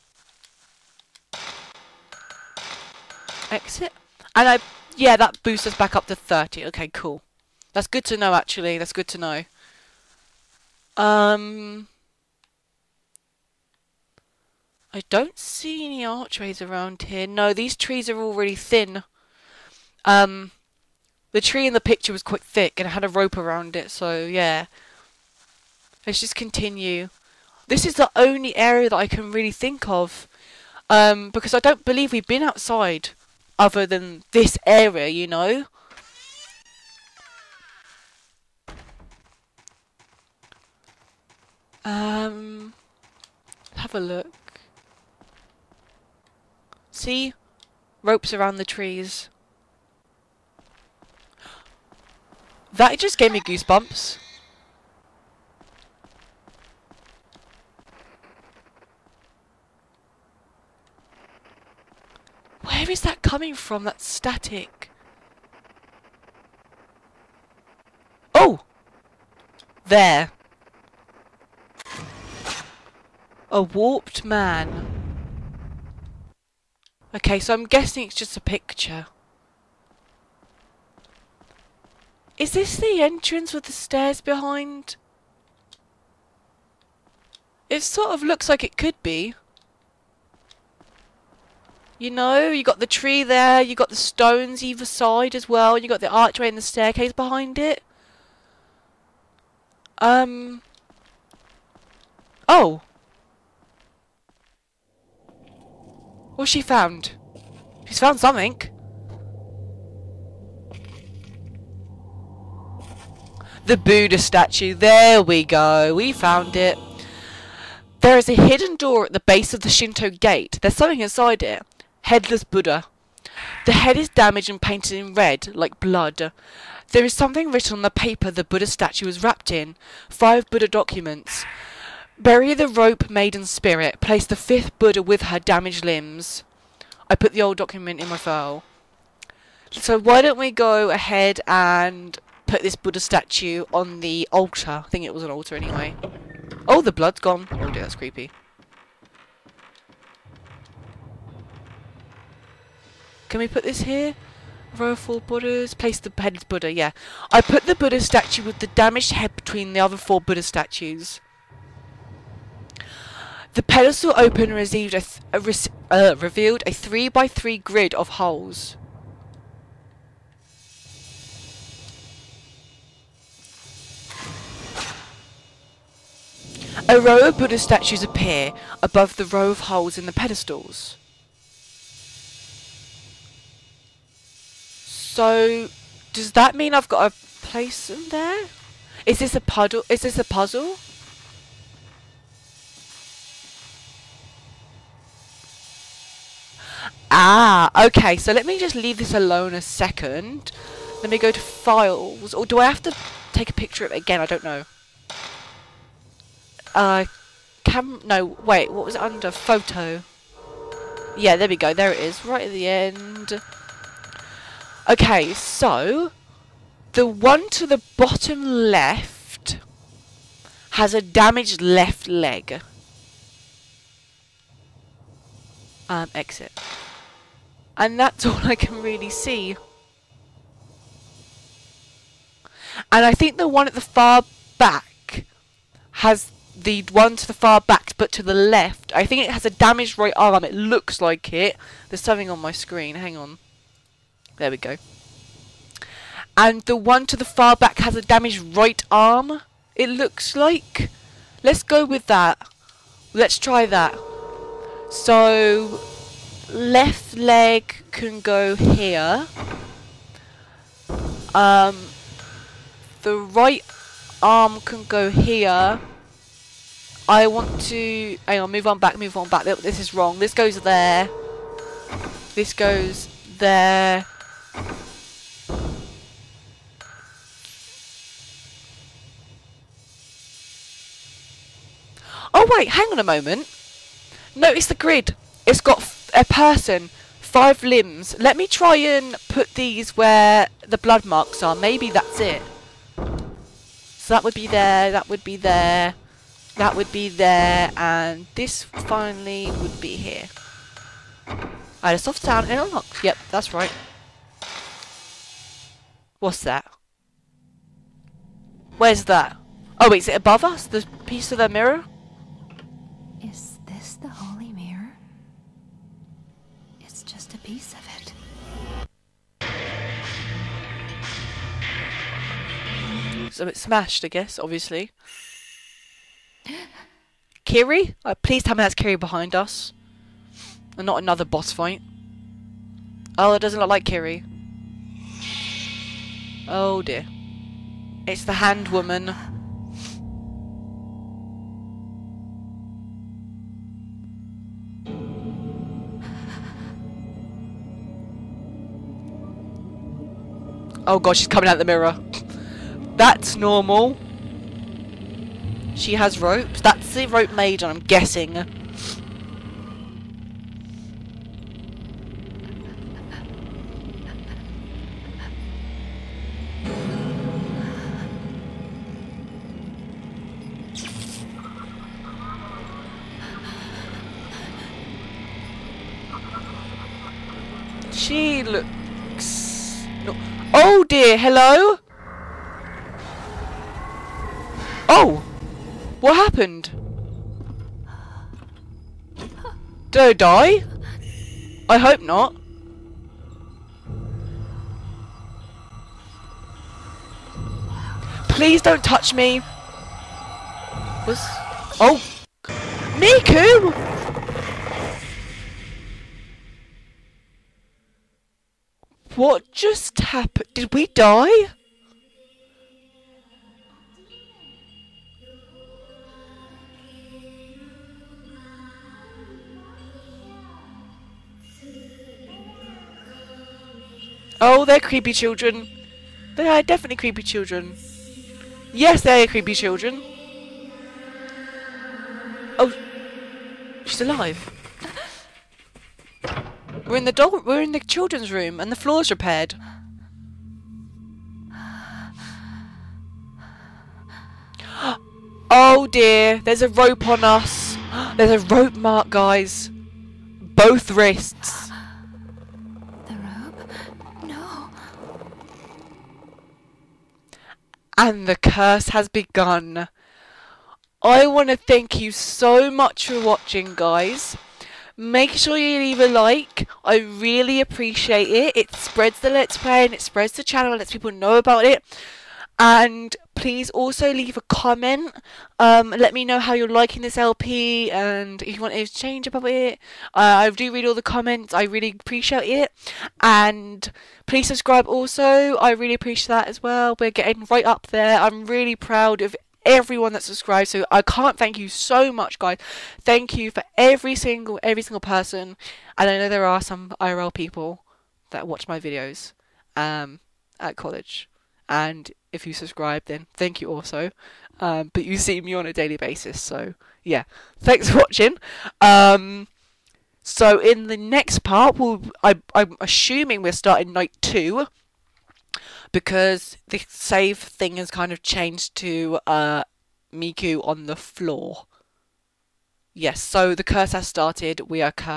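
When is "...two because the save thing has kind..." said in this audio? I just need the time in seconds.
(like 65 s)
514 s.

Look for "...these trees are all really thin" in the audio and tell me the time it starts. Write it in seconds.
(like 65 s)
17 s.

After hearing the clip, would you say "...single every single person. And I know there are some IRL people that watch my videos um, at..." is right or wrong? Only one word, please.
right.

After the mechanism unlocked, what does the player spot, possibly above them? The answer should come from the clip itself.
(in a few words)
Piece of the mirror.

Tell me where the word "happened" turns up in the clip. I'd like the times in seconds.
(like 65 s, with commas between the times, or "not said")
386 s, 409 s.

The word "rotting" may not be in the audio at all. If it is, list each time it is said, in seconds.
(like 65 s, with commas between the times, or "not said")
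not said.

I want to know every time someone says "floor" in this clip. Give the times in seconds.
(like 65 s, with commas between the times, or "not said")
438 s, 520 s.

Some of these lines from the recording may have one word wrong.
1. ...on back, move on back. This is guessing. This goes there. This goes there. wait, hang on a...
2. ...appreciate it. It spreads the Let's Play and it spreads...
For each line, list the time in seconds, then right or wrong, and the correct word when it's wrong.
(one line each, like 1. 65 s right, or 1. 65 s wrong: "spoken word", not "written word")
1. 268 s wrong: "wrong", not "guessing"
2. 467 s right.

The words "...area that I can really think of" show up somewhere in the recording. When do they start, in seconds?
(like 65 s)
28 s.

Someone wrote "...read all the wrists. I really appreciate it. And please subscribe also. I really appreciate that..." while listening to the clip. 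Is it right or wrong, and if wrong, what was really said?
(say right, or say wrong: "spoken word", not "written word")
wrong: "comments", not "wrists".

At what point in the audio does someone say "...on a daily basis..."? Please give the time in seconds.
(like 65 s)
505 s.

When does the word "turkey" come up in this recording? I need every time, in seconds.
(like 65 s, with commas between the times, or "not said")
not said.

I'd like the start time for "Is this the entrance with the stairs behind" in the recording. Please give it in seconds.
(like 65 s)
82 s.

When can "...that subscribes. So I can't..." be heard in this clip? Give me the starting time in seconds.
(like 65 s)
490 s.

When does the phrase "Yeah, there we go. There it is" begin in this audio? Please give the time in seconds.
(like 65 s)
211 s.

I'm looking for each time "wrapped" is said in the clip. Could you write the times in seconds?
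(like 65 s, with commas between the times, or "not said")
129 s.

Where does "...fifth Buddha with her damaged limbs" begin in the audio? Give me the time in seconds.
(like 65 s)
134 s.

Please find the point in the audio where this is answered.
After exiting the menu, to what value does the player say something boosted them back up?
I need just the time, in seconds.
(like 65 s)
6 s.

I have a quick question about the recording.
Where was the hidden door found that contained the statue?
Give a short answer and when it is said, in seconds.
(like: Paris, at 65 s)
At the base of the Shinto gate, at 119 s.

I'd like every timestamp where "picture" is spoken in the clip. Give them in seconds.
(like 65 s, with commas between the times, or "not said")
21 s, 78 s, 203 s.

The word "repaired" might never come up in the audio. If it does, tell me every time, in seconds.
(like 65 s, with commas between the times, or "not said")
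439 s.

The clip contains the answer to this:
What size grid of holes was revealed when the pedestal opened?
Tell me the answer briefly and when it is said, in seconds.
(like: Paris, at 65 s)
3 by 3, at 166 s.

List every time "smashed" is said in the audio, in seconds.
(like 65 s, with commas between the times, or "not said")
323 s.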